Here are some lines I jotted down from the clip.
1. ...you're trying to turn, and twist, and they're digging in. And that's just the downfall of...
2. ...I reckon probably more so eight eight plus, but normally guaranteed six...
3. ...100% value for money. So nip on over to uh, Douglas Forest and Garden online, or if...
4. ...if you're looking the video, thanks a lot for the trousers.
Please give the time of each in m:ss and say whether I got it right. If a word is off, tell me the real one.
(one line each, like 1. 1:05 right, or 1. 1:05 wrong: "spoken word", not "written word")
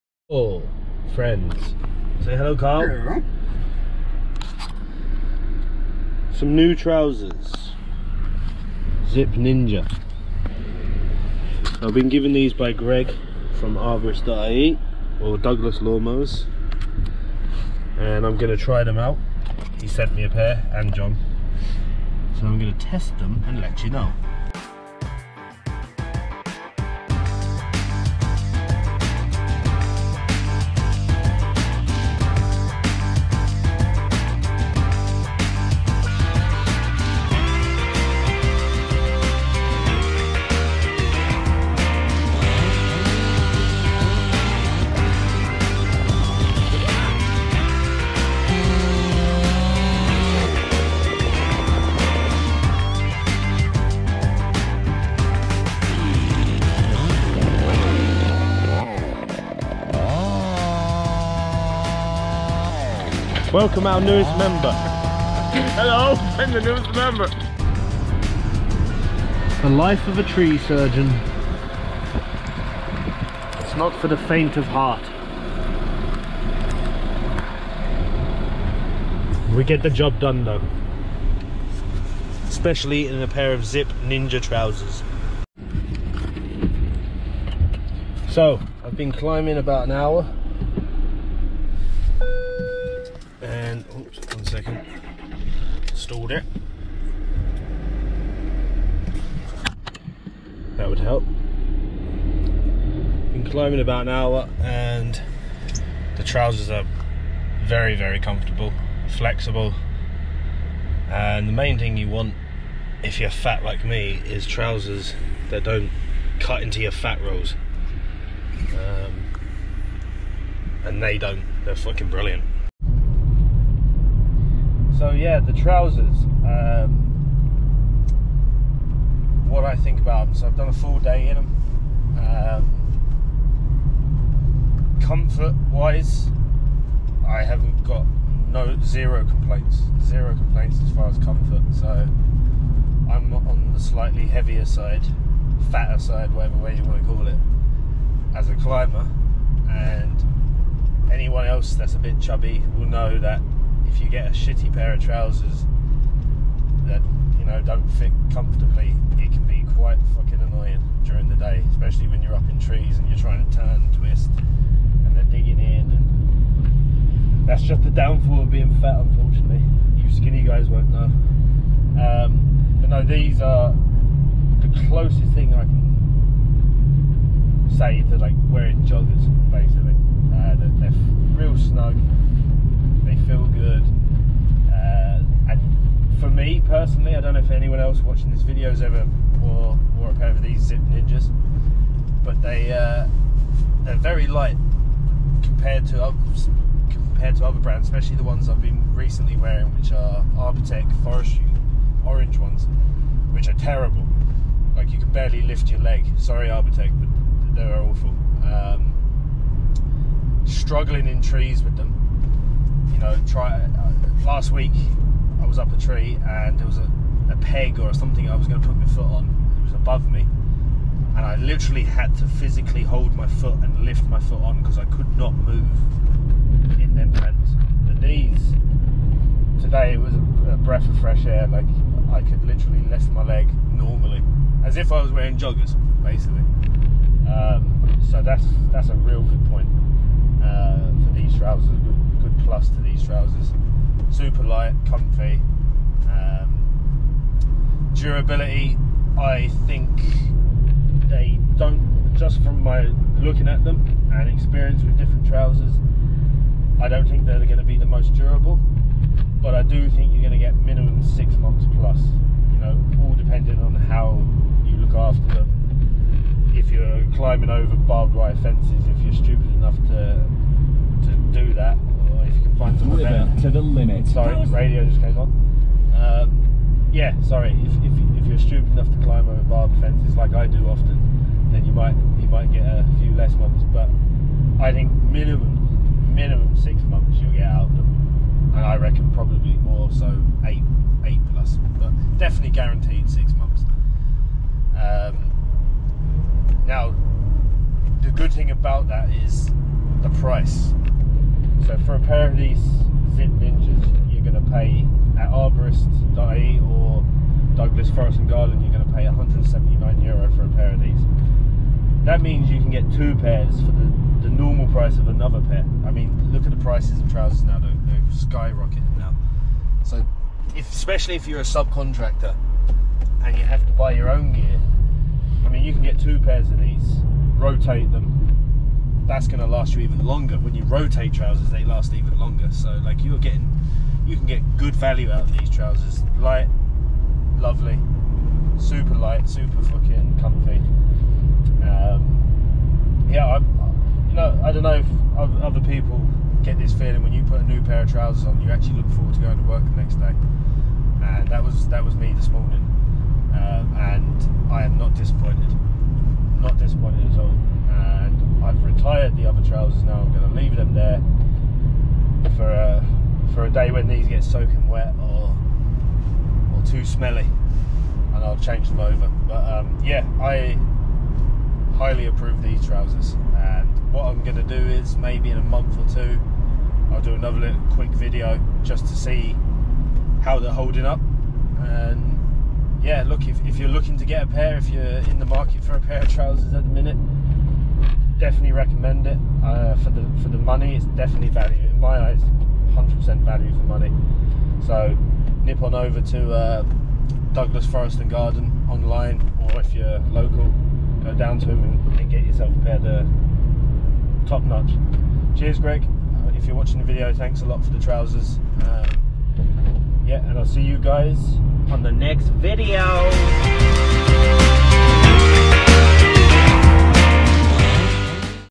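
1. 2:43 right
2. 4:48 wrong: "definitely", not "normally"
3. 6:32 right
4. 6:46 wrong: "watching", not "looking".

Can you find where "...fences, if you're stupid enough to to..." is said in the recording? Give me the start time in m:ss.
4:28.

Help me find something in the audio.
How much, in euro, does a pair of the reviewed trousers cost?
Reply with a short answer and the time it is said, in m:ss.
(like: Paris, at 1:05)
179 euro, at 5:09.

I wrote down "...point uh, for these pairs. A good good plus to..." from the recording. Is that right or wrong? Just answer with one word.
wrong.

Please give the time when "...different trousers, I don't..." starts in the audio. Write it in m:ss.
4:14.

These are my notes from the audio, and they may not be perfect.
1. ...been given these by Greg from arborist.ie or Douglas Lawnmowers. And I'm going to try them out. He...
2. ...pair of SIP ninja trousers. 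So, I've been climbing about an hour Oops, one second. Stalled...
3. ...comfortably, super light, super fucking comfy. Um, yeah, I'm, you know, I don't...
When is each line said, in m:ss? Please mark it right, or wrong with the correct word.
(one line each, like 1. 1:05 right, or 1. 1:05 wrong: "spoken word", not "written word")
1. 0:11 right
2. 1:23 right
3. 5:37 wrong: "lovely", not "comfortably".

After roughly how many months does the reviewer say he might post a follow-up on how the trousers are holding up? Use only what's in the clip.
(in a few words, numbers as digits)
a month or two.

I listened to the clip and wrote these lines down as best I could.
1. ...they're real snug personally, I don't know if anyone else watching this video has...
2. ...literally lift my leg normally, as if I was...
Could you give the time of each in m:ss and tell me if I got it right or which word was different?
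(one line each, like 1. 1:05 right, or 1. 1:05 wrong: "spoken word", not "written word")
1. 3:00 right
2. 3:52 right.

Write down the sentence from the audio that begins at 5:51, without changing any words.
And that was that was me this morning, um, and I am not disappointed.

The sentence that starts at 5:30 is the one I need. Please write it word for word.
When you rotate trousers, they last even longer.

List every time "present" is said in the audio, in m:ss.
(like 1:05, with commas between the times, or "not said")
not said.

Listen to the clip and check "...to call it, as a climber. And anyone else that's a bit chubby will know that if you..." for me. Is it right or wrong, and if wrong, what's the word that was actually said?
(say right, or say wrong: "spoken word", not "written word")
right.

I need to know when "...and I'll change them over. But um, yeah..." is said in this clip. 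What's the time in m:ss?
6:08.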